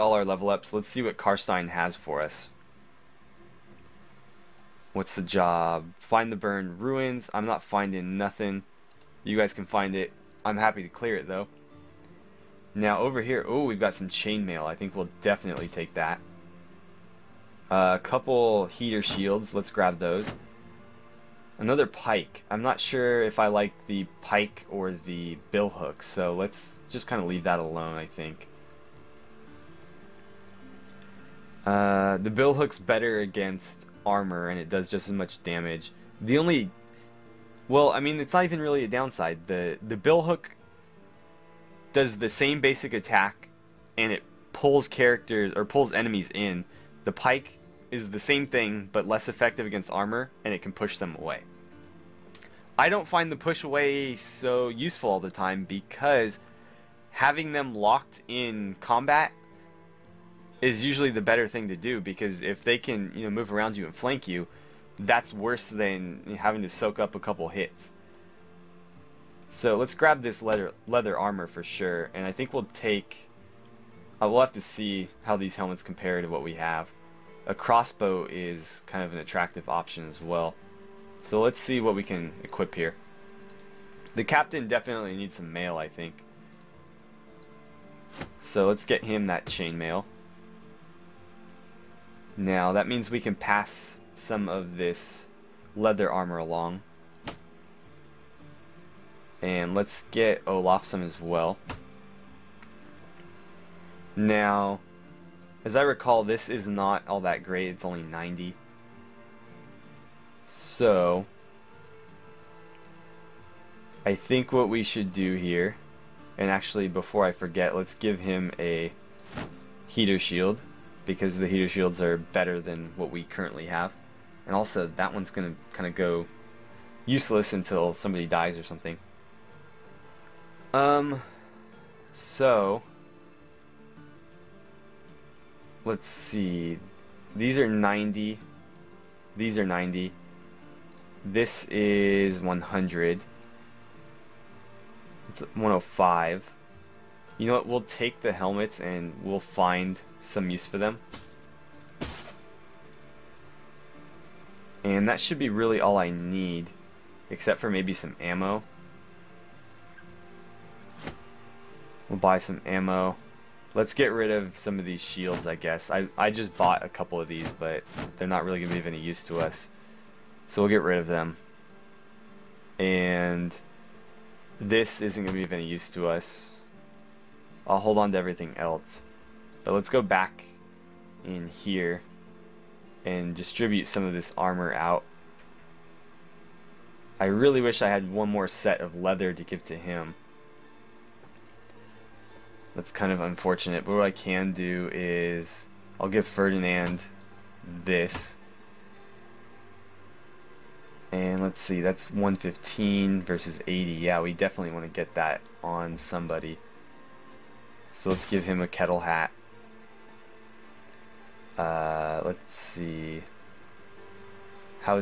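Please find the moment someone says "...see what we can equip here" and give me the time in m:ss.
1:21.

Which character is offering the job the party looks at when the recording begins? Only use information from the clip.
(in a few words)
Karstein.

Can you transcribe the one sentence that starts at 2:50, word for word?
So we'll get rid of them.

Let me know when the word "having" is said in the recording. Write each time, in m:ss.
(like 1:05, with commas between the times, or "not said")
0:57, 1:06.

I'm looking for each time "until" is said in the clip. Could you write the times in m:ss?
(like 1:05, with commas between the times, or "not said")
2:07.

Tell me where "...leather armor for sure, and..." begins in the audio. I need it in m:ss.
1:10.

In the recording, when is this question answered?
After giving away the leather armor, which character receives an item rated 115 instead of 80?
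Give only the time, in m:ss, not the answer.
3:16.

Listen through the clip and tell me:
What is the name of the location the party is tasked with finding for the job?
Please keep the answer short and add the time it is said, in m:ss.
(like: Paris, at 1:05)
burned ruins, at 0:06.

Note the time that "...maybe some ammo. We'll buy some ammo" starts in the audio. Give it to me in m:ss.
2:37.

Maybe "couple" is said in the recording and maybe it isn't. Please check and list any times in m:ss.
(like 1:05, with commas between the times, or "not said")
0:18, 1:07, 2:46.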